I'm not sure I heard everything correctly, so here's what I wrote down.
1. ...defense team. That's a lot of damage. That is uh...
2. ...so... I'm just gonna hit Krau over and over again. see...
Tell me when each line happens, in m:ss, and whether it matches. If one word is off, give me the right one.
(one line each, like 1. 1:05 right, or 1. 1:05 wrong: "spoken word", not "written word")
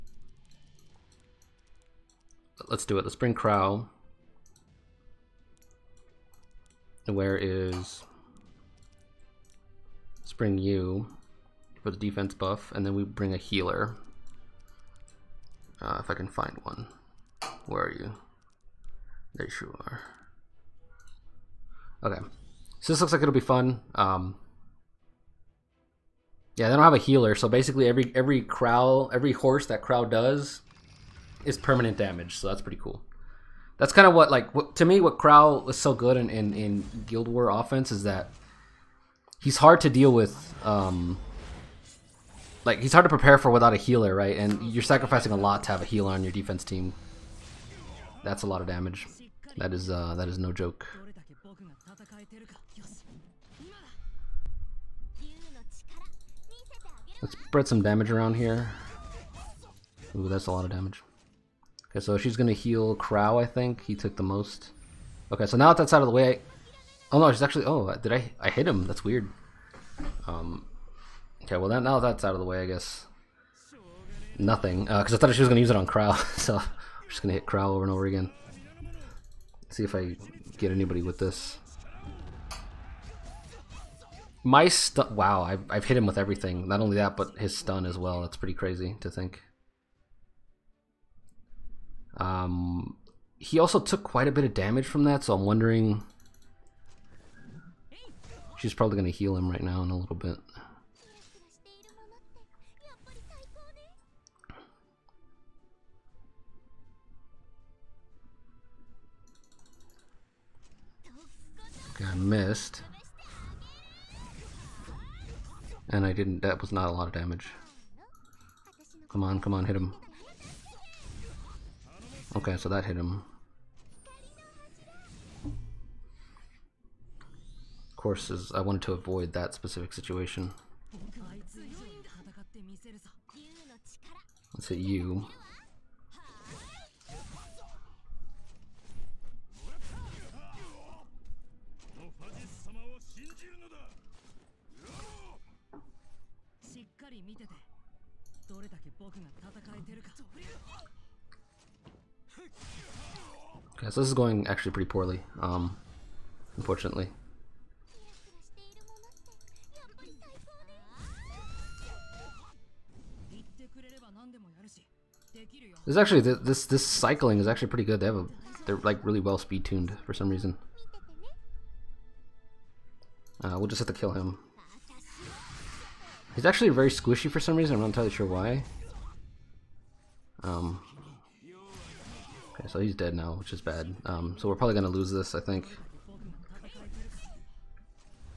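1. 0:46 right
2. 1:16 right.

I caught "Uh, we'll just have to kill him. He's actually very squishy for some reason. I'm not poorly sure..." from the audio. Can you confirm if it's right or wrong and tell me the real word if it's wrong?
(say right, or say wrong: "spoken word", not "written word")
wrong: "entirely", not "poorly".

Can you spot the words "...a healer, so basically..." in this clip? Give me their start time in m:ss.
0:26.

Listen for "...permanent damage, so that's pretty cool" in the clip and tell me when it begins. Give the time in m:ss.
0:31.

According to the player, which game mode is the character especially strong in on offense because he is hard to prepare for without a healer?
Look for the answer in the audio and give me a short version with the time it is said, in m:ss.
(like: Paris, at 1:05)
Guild War, at 0:37.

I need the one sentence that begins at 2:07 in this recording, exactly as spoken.
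Of course, is I wanted to avoid that specific situation.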